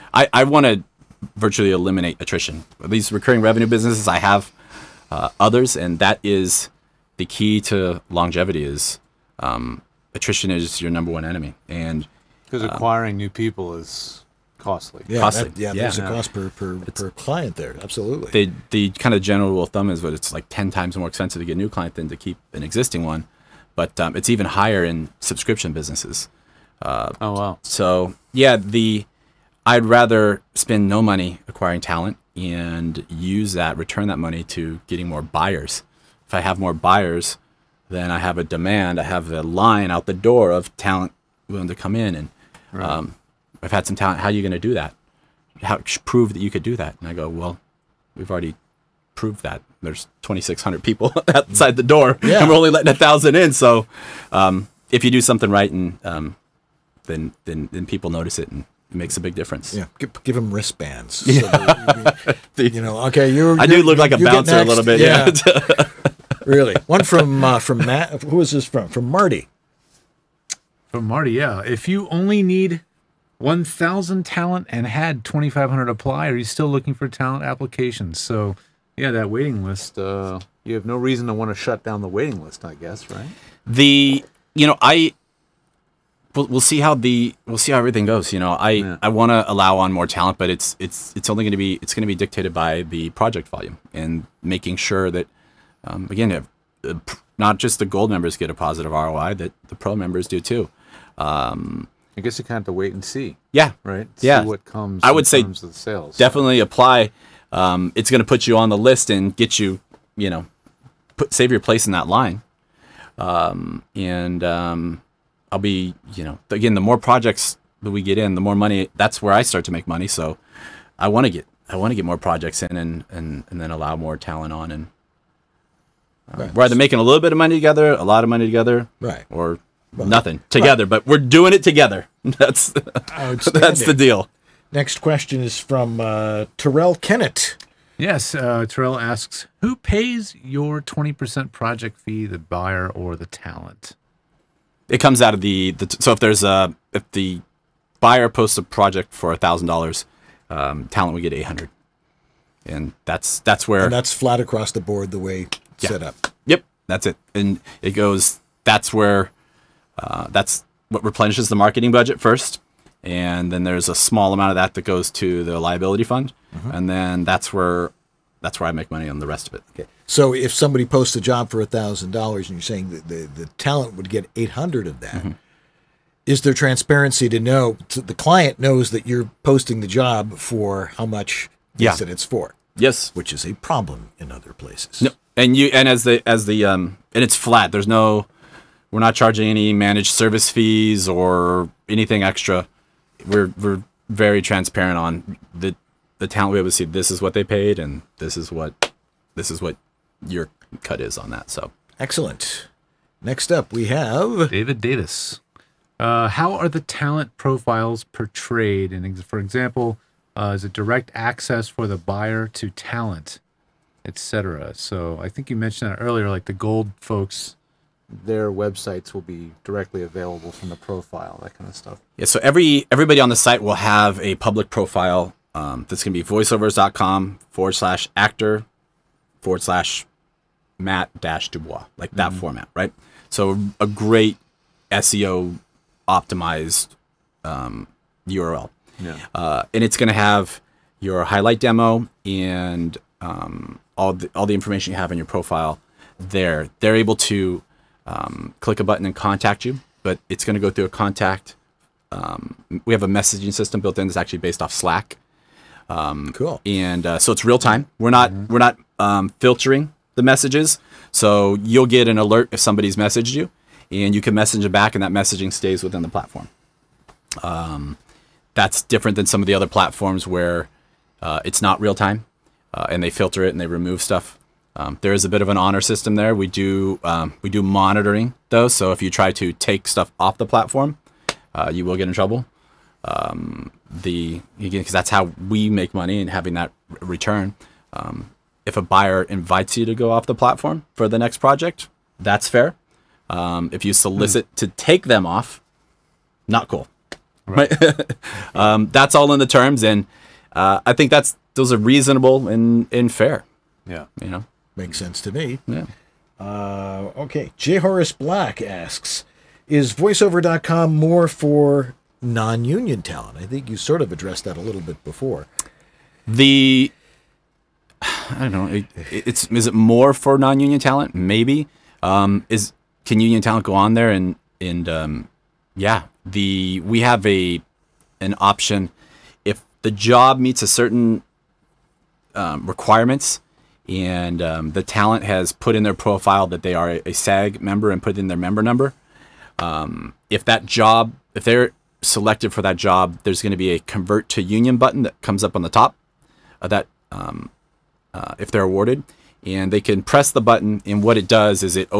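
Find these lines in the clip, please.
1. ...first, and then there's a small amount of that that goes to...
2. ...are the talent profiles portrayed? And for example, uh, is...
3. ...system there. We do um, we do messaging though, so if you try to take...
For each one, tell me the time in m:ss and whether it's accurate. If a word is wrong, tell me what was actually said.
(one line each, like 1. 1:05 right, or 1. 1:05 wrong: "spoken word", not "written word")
1. 2:42 right
2. 3:26 right
3. 4:35 wrong: "monitoring", not "messaging".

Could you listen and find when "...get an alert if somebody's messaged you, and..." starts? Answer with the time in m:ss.
4:21.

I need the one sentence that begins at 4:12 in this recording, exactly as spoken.
Um, we have a messaging system built in that's actually based off Slack.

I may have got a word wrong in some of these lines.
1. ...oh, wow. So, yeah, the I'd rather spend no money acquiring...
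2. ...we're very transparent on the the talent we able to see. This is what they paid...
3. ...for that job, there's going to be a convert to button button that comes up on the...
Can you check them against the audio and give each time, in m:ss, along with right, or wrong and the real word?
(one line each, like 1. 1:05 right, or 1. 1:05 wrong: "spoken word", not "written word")
1. 0:27 right
2. 3:13 right
3. 5:42 wrong: "union", not "button".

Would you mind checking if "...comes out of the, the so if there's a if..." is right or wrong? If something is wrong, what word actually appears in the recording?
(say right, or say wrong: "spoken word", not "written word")
right.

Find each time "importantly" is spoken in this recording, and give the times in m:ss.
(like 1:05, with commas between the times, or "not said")
not said.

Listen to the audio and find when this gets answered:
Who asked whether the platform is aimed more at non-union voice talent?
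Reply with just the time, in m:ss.
5:07.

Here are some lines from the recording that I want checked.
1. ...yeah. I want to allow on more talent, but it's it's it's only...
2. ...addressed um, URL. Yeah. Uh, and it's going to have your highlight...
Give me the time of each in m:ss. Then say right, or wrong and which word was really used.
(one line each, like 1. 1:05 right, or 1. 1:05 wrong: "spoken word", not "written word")
1. 1:28 right
2. 3:56 wrong: "optimized", not "addressed".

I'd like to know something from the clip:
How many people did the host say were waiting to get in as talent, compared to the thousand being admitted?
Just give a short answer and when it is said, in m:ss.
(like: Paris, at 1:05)
2,600, at 0:50.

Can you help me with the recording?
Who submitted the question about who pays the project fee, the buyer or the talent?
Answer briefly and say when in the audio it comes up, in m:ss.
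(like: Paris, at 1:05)
Terrell Kennett, at 2:16.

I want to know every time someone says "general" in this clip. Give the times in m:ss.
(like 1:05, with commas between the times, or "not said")
0:19.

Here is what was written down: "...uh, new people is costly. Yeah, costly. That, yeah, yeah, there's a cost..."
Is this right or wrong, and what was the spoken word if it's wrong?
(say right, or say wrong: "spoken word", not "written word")
right.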